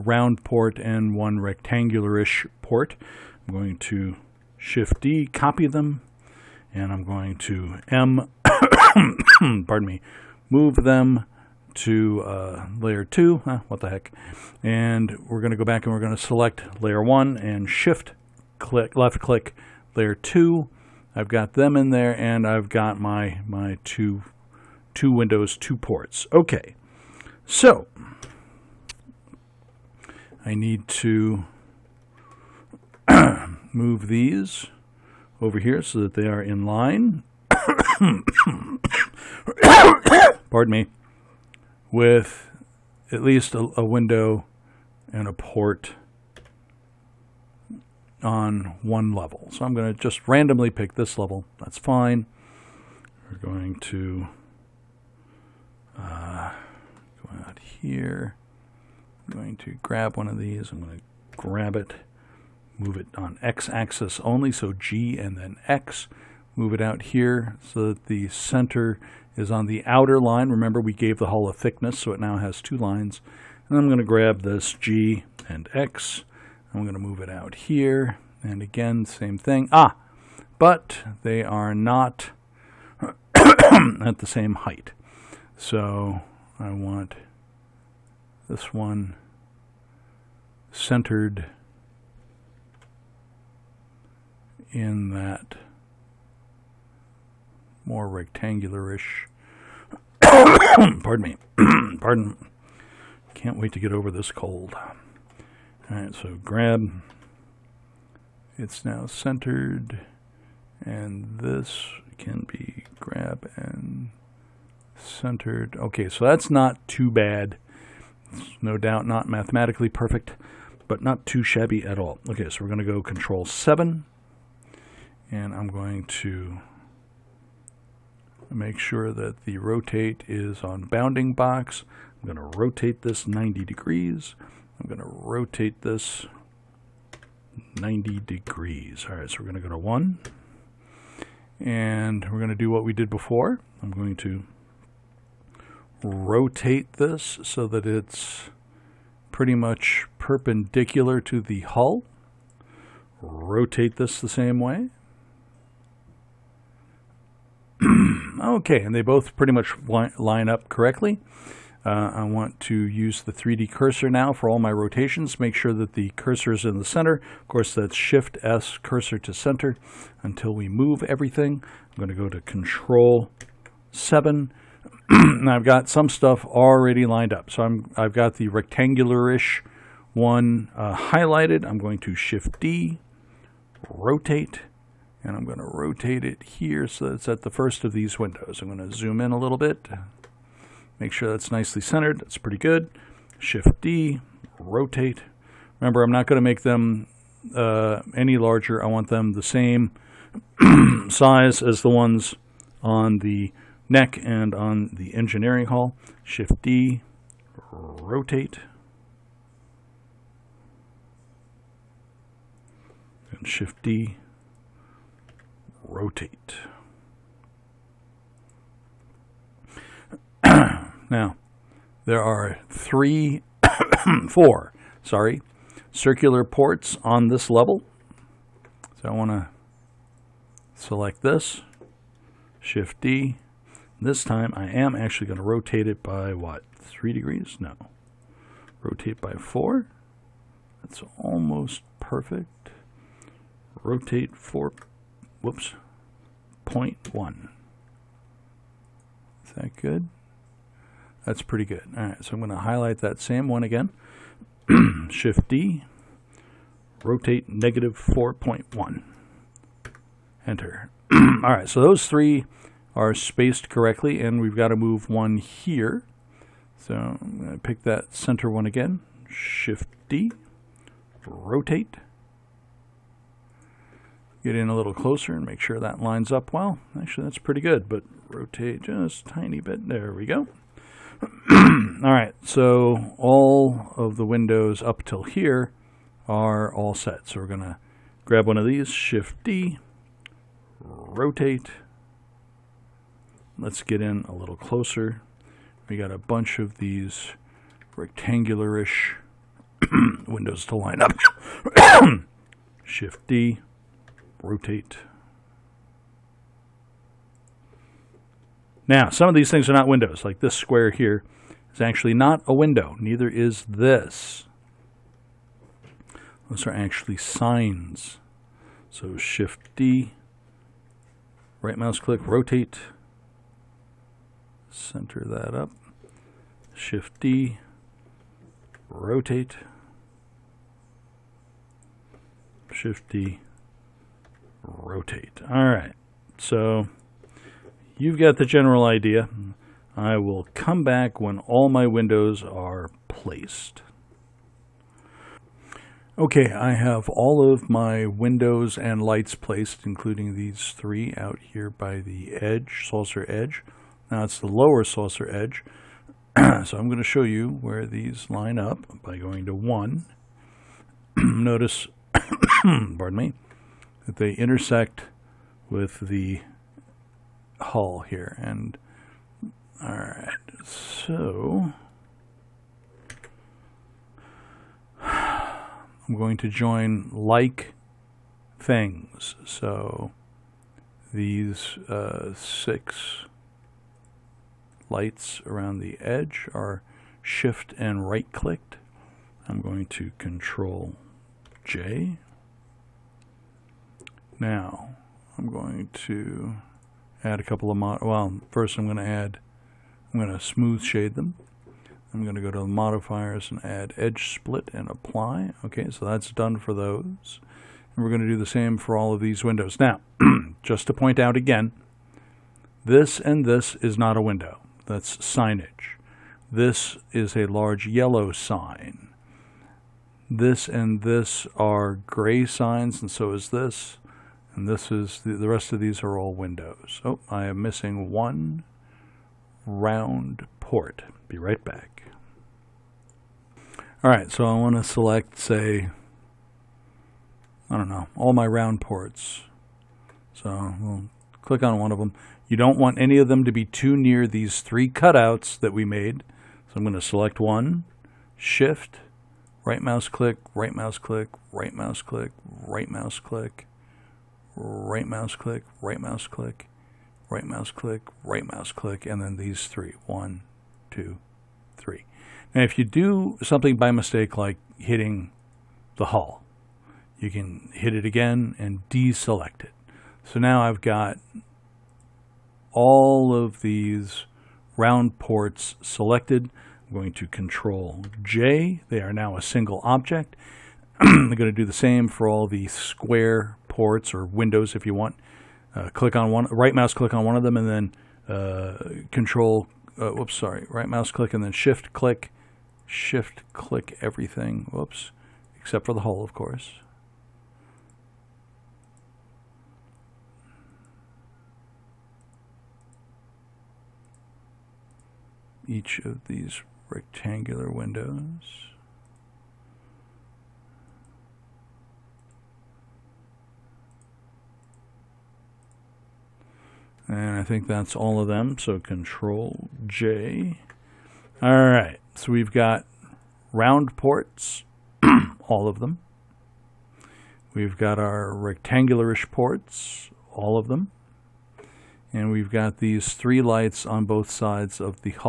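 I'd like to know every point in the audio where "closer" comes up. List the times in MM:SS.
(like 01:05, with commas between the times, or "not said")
04:34, 04:54.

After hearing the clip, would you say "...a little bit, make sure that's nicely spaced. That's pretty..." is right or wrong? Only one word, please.
wrong.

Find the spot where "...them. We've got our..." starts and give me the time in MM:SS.
08:45.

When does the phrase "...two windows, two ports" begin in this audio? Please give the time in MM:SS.
00:24.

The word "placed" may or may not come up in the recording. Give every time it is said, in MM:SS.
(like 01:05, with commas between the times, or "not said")
05:43, 05:49.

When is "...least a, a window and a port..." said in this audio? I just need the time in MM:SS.
00:43.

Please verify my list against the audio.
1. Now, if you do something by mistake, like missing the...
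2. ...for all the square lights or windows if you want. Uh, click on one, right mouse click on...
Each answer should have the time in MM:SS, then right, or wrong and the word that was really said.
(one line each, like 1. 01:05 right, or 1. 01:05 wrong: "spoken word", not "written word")
1. 07:42 wrong: "hitting", not "missing"
2. 08:02 wrong: "ports", not "lights".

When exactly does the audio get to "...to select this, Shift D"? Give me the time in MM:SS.
03:49.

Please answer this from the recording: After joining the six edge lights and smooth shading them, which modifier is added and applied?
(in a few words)
edge split.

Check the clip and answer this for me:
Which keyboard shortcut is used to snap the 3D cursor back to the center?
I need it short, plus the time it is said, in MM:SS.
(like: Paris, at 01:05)
Shift S, at 02:47.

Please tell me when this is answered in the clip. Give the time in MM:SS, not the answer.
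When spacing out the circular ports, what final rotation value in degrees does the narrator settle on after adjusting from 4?
04:06.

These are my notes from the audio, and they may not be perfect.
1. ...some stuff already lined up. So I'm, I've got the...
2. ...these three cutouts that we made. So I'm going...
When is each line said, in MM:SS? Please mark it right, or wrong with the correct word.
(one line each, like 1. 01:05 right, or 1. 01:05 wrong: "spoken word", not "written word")
1. 02:55 right
2. 07:24 right.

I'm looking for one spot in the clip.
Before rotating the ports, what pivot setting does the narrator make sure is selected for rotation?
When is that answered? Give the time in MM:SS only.
02:10.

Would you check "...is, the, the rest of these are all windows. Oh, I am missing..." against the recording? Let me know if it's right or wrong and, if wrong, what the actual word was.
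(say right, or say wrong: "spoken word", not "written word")
right.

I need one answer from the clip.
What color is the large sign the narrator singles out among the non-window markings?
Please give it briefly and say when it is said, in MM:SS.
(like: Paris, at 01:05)
yellow, at 06:57.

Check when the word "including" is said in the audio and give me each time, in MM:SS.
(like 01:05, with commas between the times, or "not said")
05:49.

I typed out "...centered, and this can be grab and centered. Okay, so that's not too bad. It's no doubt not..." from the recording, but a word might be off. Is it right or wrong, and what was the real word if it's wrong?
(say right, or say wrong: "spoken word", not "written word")
right.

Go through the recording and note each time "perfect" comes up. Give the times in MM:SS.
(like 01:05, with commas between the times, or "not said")
01:59, 04:01.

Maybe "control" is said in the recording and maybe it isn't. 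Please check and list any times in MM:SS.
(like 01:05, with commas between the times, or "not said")
02:03, 02:52, 06:30, 07:57, 08:09, 08:38.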